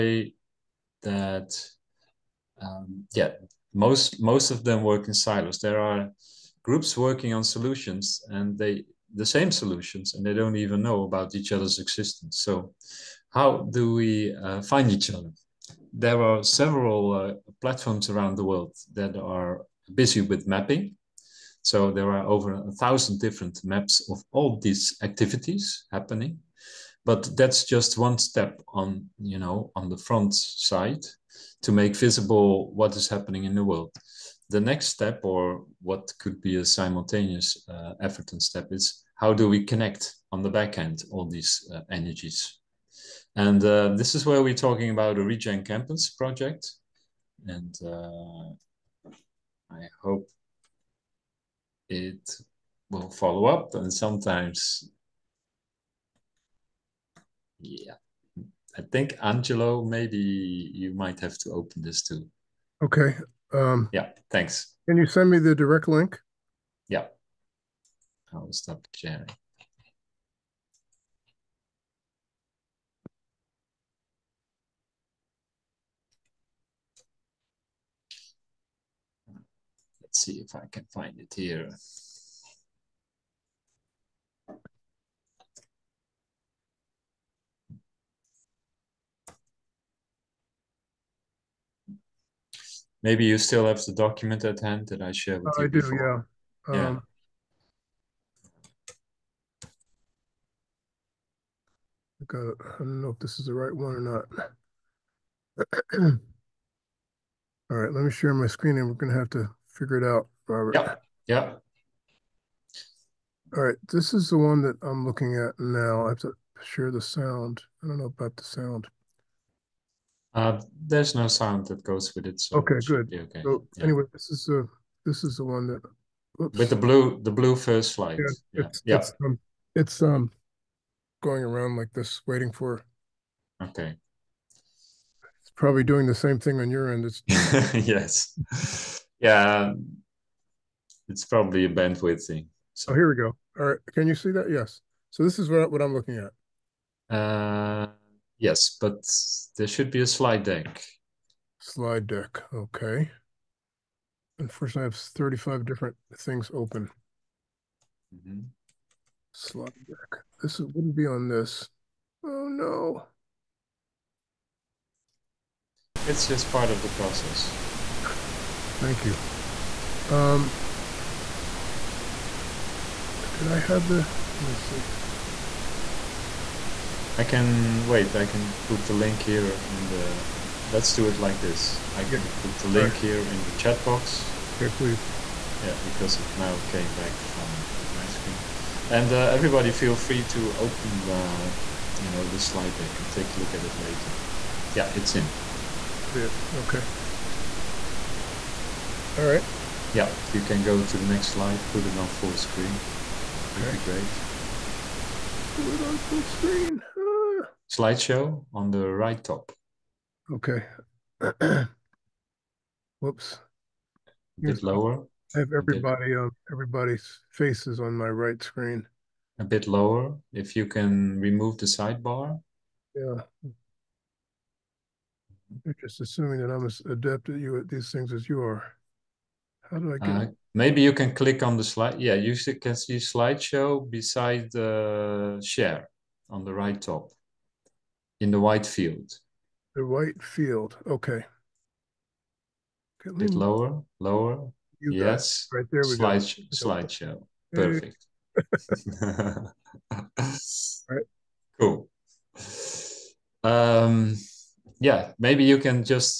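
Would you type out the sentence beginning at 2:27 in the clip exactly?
Uh, yes, but there should be a slide deck.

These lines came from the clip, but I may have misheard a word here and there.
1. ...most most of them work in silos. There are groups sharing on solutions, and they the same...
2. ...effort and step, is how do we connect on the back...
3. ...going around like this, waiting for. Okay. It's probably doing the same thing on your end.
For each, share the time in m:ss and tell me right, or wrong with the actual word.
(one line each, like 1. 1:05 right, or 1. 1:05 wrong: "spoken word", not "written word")
1. 0:03 wrong: "working", not "sharing"
2. 0:38 right
3. 2:11 right.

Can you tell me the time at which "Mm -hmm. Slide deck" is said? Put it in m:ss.
2:38.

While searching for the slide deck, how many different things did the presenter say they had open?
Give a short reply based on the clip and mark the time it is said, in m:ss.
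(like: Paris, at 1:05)
35, at 2:34.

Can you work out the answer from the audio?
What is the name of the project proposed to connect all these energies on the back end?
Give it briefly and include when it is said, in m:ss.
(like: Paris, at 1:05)
Regen Campus, at 0:45.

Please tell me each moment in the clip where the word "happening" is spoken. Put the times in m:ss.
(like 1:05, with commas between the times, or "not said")
0:25, 0:33.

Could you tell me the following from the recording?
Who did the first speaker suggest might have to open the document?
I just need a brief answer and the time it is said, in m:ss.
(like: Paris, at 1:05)
Angelo, at 0:59.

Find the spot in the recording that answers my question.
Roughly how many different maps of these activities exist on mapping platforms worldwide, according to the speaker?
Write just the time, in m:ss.
0:22.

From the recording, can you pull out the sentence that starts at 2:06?
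with the blue the blue first light.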